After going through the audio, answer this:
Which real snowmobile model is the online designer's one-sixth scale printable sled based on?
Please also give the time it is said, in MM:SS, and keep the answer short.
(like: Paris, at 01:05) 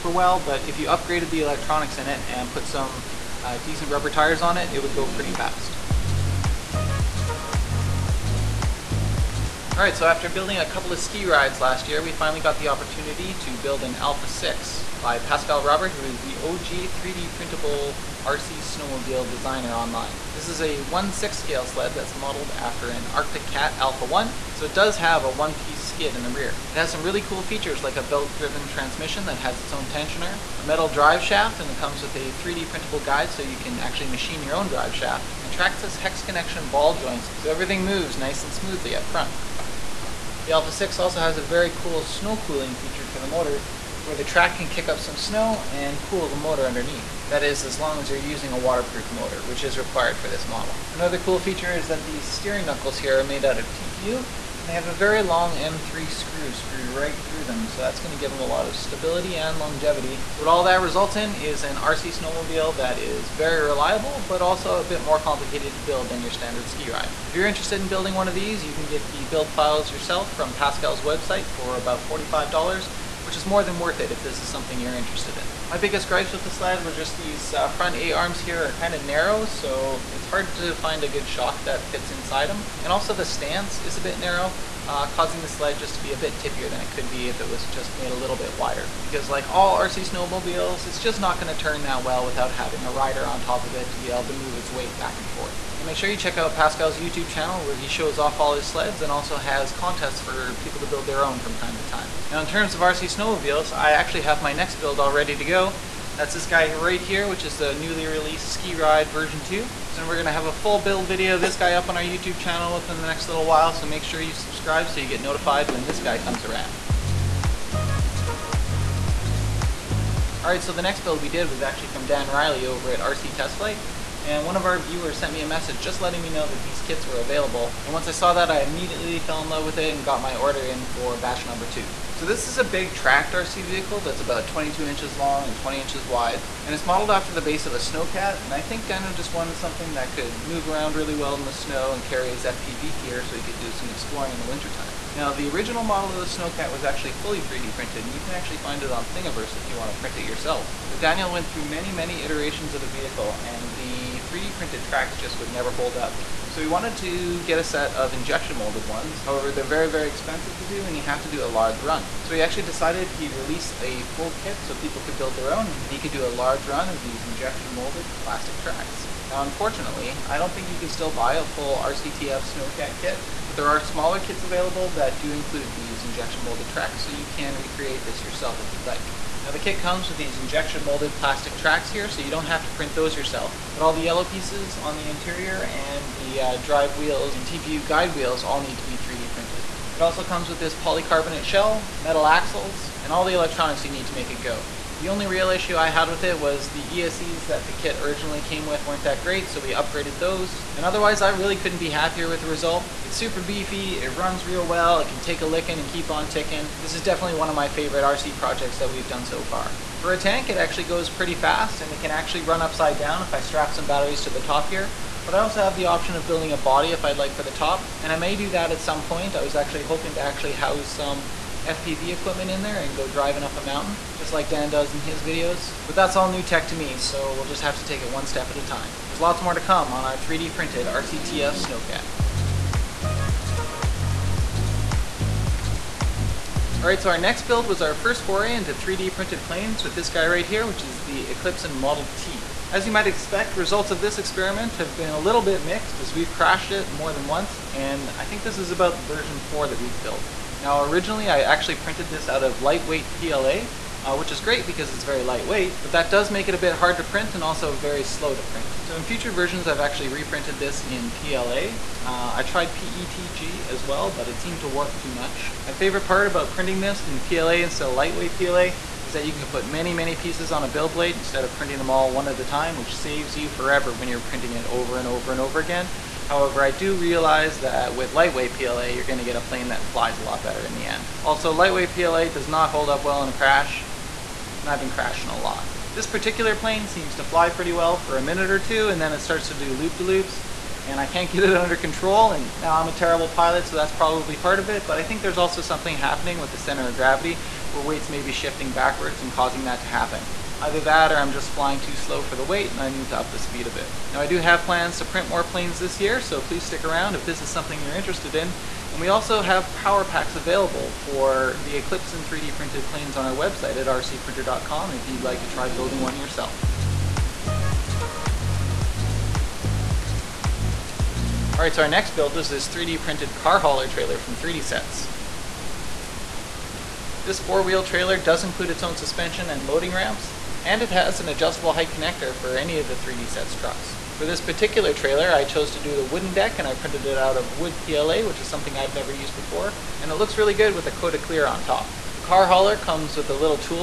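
Arctic Cat Alpha 1, at 00:23.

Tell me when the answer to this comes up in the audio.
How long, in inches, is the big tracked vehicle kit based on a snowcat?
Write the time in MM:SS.
02:14.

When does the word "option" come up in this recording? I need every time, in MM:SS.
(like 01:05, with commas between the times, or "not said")
03:35.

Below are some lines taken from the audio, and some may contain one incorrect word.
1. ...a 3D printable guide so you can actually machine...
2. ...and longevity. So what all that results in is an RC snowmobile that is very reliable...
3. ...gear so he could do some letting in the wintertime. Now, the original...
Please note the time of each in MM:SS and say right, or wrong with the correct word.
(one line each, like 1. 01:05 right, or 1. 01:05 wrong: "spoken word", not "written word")
1. 00:32 right
2. 00:59 right
3. 02:22 wrong: "exploring", not "letting".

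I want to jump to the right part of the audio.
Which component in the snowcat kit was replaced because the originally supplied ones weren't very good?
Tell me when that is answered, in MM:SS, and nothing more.
03:17.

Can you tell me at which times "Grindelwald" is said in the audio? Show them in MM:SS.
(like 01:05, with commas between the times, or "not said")
not said.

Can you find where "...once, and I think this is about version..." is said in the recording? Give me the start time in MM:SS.
04:07.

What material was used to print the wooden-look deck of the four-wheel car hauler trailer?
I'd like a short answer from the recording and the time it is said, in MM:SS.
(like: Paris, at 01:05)
wood PLA, at 05:37.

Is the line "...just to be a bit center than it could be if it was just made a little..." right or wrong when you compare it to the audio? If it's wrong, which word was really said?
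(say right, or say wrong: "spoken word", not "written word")
wrong: "tippier", not "center".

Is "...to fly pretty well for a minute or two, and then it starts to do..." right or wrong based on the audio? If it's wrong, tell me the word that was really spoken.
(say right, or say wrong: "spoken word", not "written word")
right.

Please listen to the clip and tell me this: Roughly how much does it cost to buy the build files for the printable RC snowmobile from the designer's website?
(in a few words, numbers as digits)
$45.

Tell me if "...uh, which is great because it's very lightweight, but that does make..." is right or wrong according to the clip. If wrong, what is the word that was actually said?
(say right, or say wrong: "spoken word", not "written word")
right.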